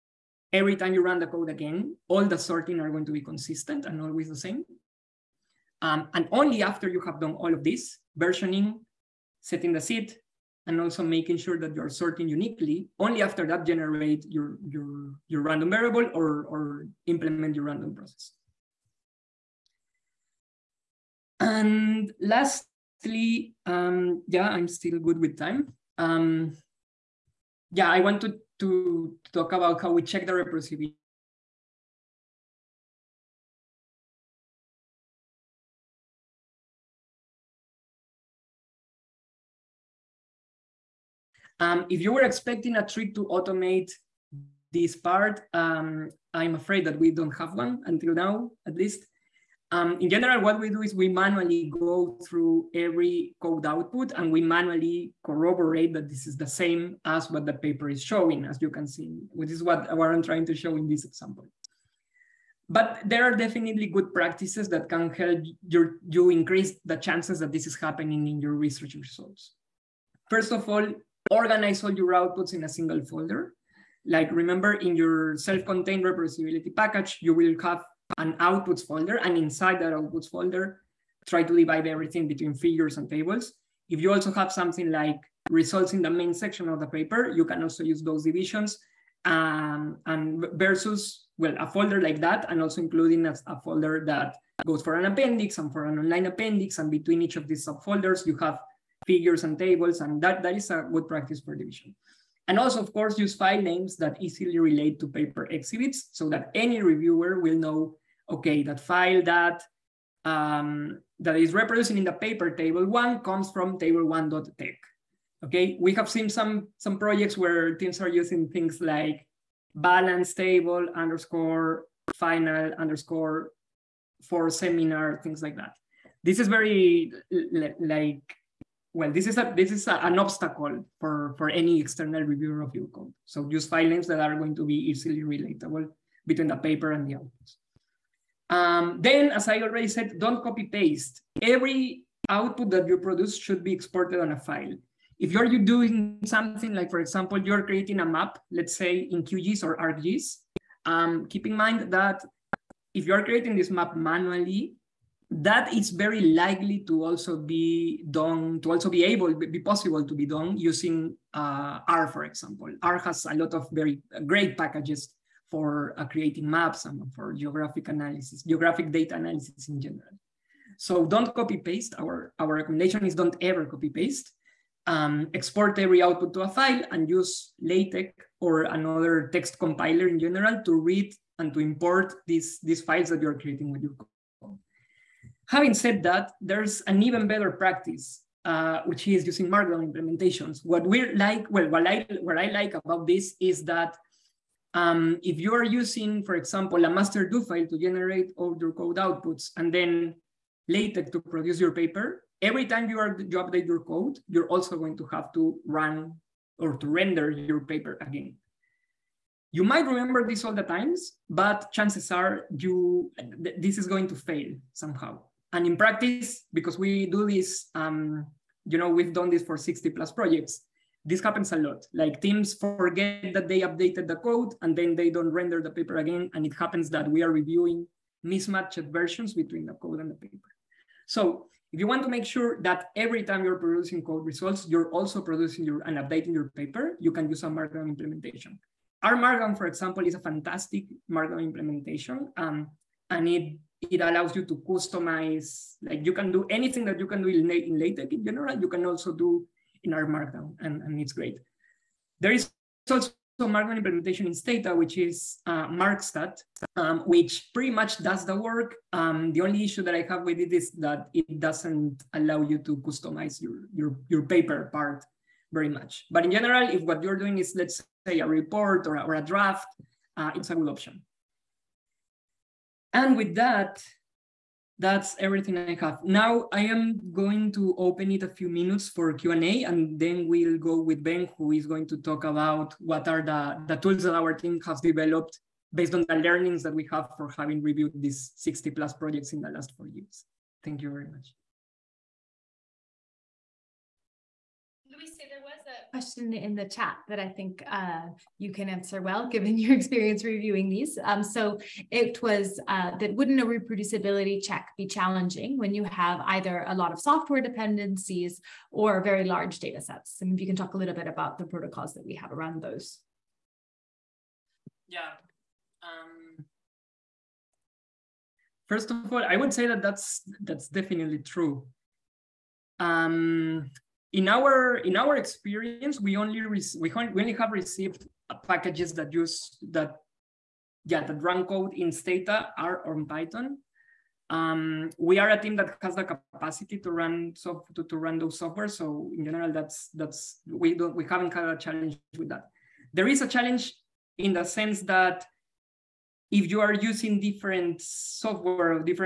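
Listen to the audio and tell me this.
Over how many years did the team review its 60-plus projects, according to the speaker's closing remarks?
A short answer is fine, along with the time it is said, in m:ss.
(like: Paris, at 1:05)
4, at 4:49.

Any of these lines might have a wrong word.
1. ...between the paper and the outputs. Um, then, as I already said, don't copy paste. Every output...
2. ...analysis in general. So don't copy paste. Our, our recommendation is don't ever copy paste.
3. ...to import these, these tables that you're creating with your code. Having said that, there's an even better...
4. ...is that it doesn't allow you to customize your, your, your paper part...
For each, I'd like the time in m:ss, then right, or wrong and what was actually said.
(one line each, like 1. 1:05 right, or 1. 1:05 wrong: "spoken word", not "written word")
1. 2:16 right
2. 2:49 right
3. 3:01 wrong: "files", not "tables"
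4. 4:20 right.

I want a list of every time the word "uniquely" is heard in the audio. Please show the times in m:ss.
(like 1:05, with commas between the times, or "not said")
0:12.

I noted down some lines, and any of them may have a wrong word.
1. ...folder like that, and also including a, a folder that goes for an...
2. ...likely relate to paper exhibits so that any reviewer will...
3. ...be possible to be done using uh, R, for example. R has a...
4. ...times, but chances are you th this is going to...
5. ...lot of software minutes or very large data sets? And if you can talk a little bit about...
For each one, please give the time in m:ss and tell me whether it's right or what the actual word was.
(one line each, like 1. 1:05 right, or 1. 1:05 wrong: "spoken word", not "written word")
1. 1:31 right
2. 1:44 wrong: "easily", not "likely"
3. 2:39 right
4. 3:30 right
5. 5:06 wrong: "dependencies", not "minutes".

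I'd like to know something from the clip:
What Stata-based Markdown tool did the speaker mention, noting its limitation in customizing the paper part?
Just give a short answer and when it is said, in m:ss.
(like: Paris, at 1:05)
Markstat, at 4:15.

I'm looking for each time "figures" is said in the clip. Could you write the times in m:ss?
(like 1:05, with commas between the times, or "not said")
1:22, 1:39.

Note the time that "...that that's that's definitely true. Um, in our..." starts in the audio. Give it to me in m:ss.
5:19.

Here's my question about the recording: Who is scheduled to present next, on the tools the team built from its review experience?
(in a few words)
Ben.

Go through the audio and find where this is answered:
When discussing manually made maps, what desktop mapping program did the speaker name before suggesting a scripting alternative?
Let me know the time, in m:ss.
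2:29.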